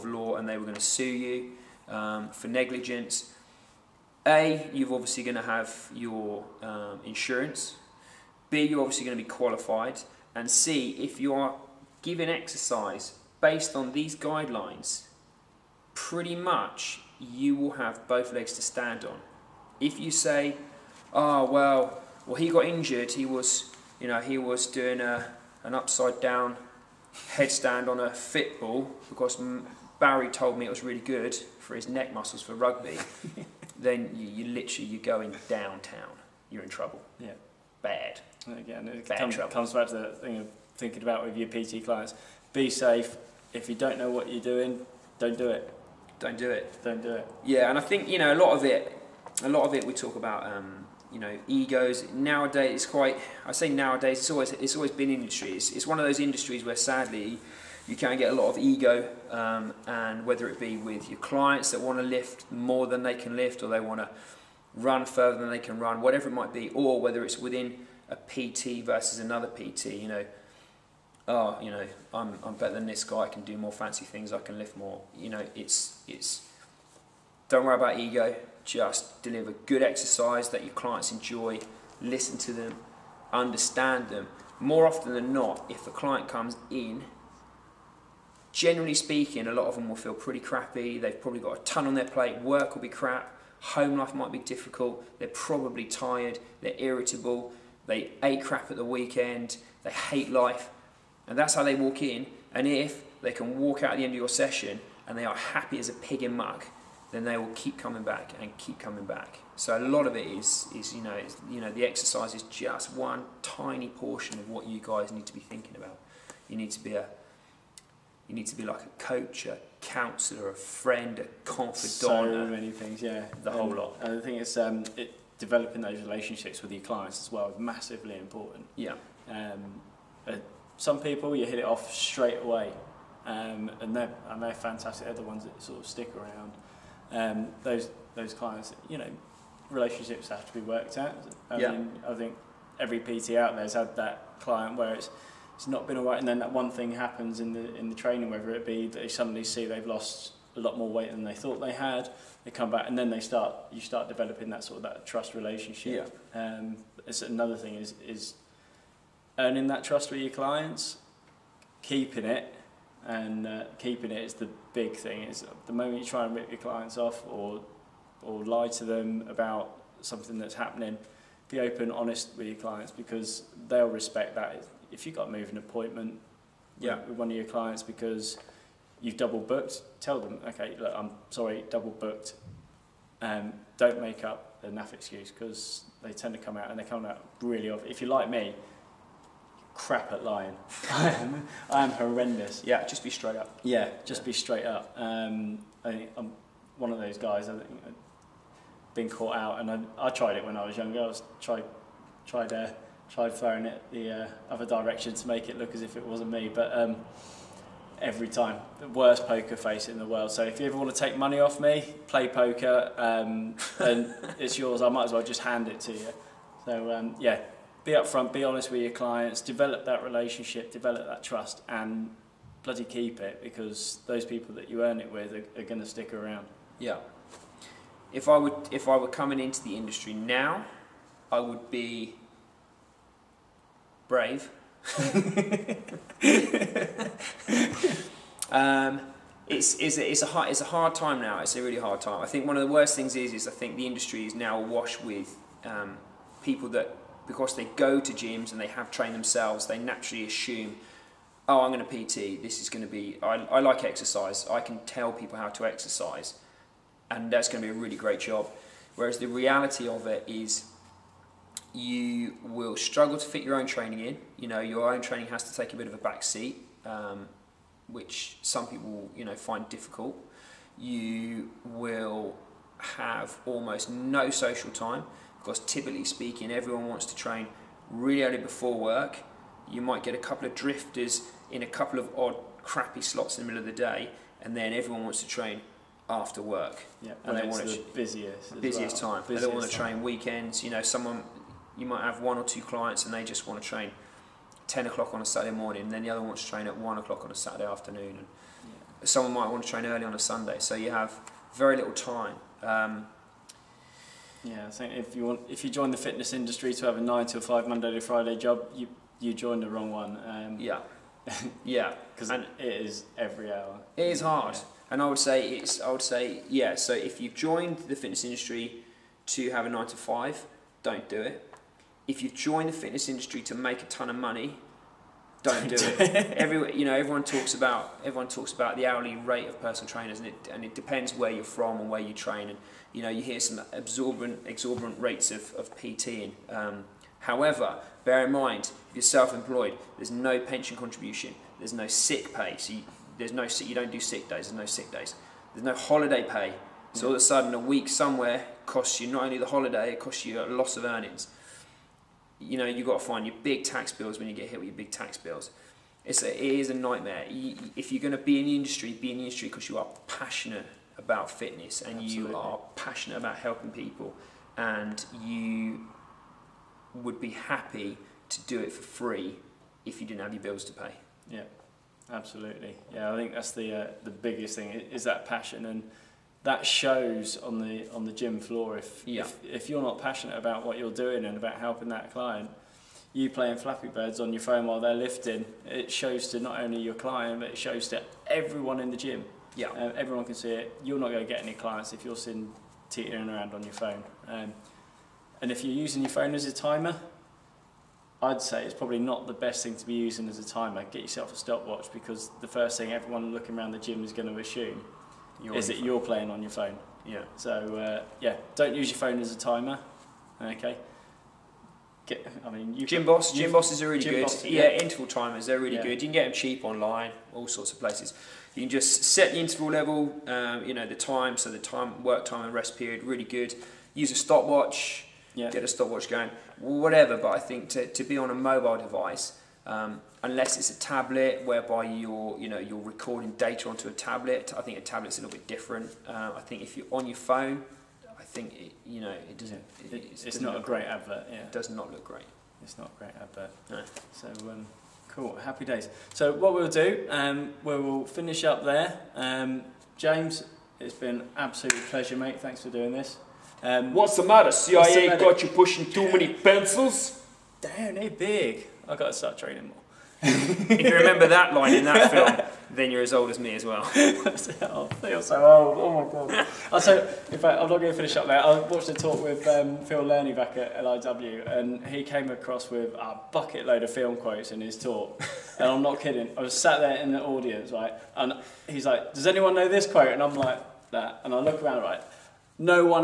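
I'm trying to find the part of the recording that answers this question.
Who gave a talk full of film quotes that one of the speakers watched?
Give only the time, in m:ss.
7:49.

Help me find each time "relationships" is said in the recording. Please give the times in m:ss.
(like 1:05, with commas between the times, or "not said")
2:06, 2:19, 2:35, 3:40.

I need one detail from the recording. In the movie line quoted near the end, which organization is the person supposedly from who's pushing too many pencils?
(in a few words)
CIA.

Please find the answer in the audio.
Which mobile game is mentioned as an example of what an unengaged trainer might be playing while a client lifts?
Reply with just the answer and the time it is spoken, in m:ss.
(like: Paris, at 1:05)
Flappy Birds, at 6:23.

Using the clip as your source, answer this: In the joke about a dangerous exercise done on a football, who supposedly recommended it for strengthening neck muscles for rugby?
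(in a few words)
Barry.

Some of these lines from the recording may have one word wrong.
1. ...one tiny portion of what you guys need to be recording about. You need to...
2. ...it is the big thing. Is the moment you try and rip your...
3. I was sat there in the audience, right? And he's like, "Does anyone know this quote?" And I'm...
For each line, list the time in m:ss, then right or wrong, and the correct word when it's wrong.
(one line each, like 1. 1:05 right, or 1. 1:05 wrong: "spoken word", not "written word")
1. 1:52 wrong: "thinking", not "recording"
2. 2:44 right
3. 7:56 right.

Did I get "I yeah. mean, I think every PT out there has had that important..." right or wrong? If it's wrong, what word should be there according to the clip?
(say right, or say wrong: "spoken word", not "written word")
wrong: "client", not "important".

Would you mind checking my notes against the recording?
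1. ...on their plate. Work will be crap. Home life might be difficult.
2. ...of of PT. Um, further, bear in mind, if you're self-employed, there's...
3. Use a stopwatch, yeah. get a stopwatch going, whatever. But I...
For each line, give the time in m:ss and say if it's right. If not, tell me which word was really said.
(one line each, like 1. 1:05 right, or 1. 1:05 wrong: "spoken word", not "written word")
1. 1:31 right
2. 5:35 wrong: "however", not "further"
3. 7:03 right.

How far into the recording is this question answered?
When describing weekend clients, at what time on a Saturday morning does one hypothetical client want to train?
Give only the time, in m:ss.
4:54.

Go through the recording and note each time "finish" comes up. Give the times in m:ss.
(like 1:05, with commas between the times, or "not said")
7:28, 7:47.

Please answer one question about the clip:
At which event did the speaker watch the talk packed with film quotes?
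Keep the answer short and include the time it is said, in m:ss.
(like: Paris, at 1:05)
LIW, at 7:50.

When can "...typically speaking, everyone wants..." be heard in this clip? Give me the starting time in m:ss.
4:35.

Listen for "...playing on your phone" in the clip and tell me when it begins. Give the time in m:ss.
6:45.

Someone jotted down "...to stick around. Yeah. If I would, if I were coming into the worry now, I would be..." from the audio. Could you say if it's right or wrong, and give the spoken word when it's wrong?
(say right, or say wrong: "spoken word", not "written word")
wrong: "industry", not "worry".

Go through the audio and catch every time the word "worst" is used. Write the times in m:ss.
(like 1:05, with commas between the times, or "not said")
3:28, 4:02.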